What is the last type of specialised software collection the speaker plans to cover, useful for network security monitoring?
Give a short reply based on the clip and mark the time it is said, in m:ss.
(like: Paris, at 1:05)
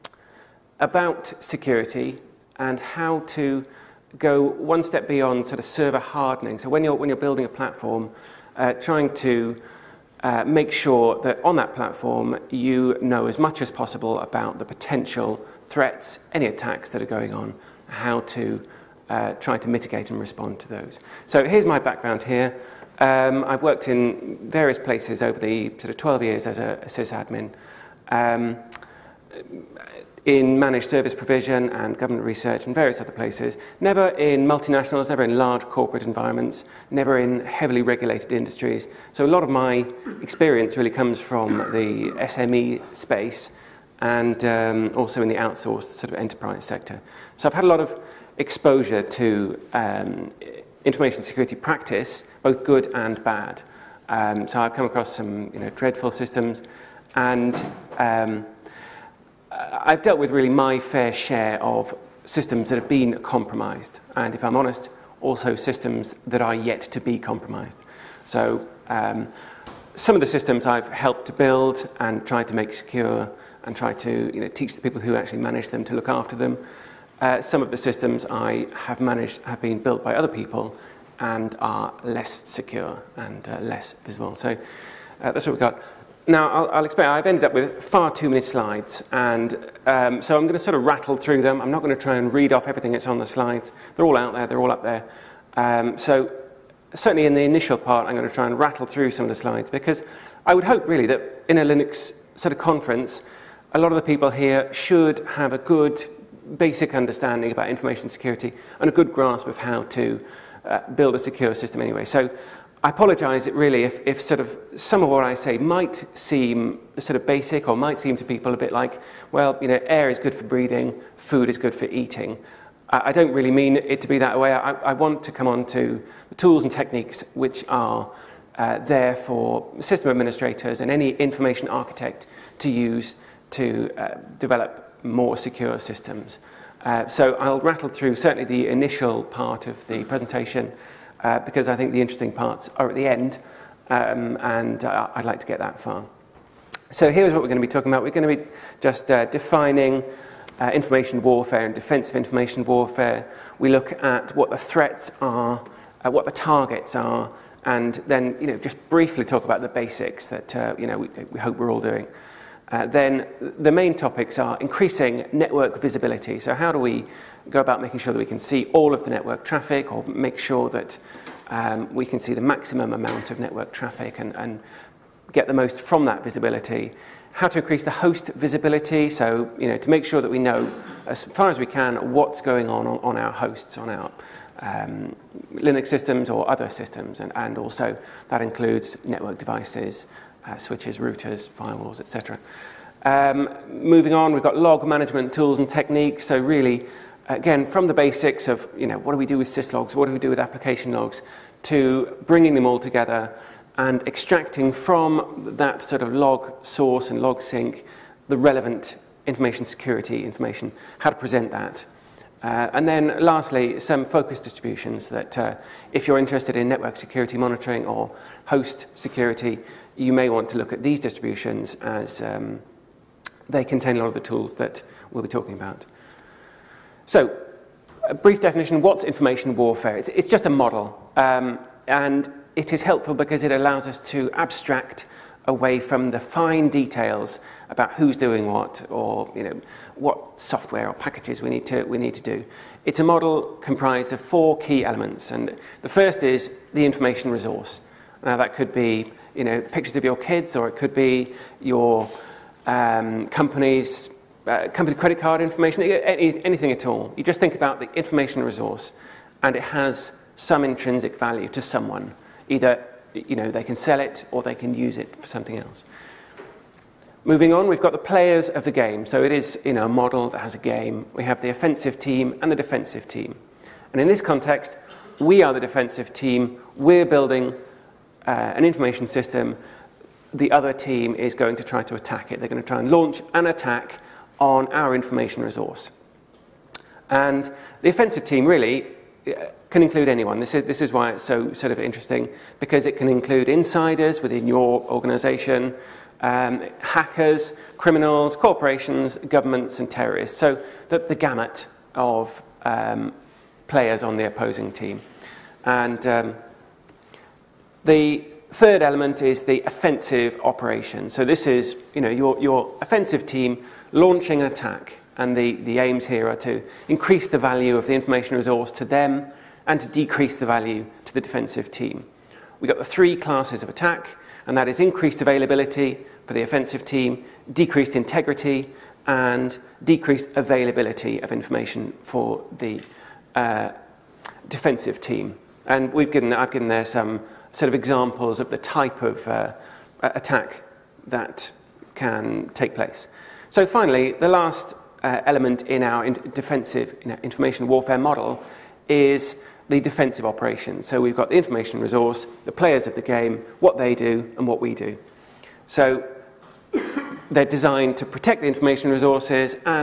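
Focus distributions, at 3:34.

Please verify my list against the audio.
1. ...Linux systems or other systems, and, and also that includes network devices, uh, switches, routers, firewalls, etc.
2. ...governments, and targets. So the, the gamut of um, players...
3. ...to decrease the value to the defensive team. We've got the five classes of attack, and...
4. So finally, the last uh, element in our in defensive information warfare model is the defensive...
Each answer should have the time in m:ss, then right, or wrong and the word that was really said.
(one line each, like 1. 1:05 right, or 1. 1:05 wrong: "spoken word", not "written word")
1. 3:05 right
2. 4:59 wrong: "terrorists", not "targets"
3. 5:19 wrong: "three", not "five"
4. 5:43 right.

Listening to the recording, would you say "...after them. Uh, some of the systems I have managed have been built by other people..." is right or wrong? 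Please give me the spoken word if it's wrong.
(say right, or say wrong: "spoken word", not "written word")
right.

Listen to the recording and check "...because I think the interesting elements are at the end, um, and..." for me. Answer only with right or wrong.
wrong.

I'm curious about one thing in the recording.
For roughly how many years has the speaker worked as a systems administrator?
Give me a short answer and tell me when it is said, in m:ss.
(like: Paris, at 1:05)
12, at 0:25.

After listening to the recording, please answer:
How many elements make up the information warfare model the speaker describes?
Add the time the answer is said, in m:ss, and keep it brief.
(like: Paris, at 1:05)
4, at 4:04.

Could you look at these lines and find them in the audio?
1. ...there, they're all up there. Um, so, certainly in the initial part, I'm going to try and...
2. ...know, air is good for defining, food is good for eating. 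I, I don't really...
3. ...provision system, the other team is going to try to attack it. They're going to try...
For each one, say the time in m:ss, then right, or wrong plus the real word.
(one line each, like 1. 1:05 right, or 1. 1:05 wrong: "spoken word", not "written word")
1. 1:34 right
2. 1:59 wrong: "breathing", not "defining"
3. 4:38 wrong: "information", not "provision".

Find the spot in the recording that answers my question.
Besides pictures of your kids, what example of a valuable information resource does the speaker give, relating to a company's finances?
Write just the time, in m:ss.
4:14.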